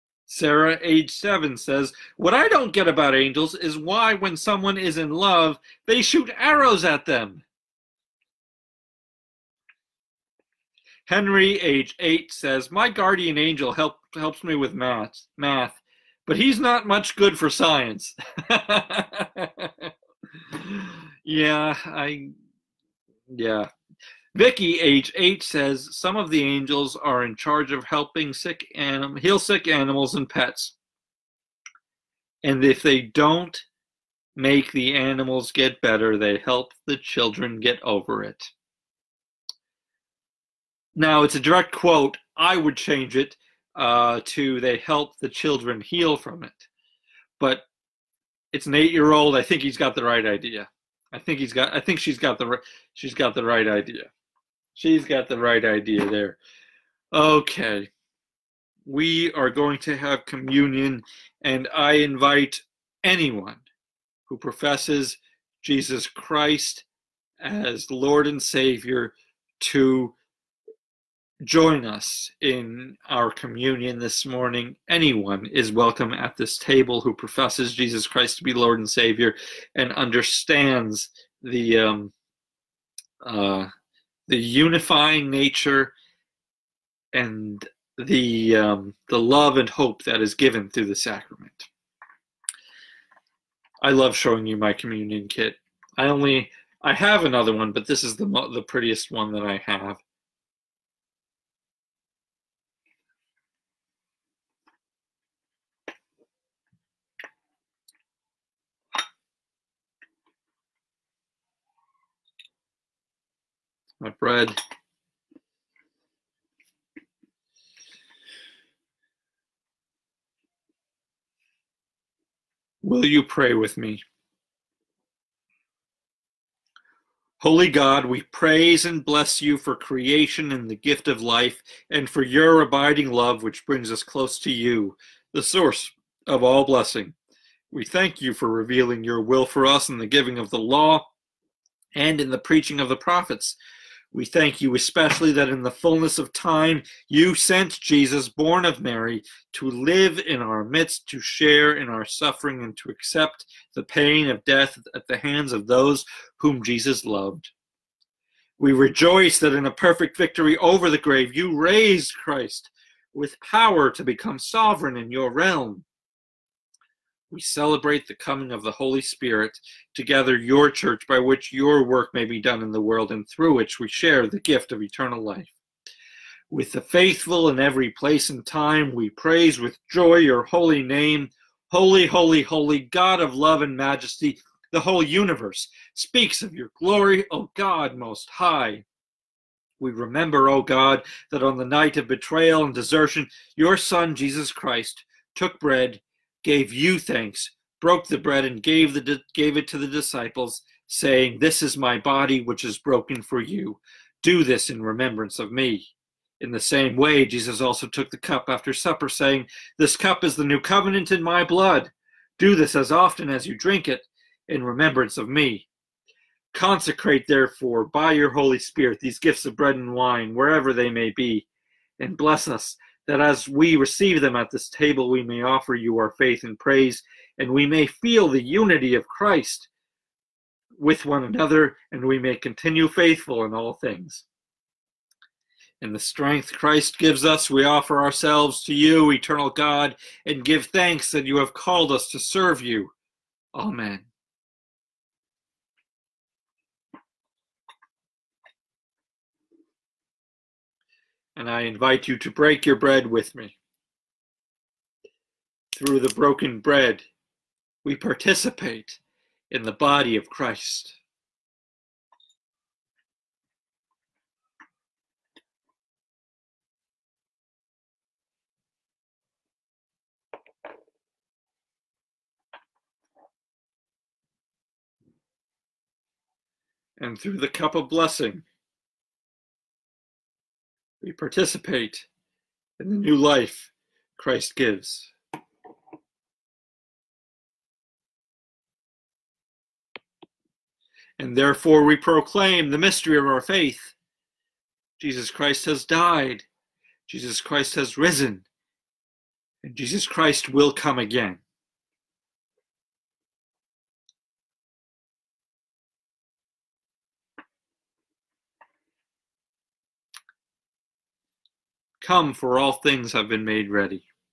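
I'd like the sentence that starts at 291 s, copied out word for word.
And therefore we proclaim the mystery of our faith.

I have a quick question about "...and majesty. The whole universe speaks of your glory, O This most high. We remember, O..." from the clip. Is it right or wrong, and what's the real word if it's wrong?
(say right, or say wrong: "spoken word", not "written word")
wrong: "God", not "This".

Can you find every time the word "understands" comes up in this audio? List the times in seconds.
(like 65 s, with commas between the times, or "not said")
79 s.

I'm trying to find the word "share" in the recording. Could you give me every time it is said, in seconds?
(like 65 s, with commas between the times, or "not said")
151 s, 173 s.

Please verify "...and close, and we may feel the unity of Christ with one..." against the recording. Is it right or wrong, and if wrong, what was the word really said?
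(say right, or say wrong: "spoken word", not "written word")
wrong: "praise", not "close".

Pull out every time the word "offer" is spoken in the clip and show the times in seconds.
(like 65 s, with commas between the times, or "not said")
225 s, 237 s.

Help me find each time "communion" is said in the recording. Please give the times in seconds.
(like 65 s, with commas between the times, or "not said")
60 s, 73 s, 94 s.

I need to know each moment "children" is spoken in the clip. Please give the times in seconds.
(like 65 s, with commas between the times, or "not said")
36 s, 45 s.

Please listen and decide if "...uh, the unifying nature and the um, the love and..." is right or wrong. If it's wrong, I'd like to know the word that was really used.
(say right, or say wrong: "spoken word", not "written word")
right.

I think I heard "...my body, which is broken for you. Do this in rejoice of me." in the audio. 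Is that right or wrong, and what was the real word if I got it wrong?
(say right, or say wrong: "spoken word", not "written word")
wrong: "remembrance", not "rejoice".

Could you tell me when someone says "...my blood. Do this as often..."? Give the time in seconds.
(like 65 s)
211 s.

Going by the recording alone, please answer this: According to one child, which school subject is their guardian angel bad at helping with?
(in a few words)
Science.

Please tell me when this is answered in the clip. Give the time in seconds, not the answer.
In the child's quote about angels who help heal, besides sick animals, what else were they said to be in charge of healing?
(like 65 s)
30 s.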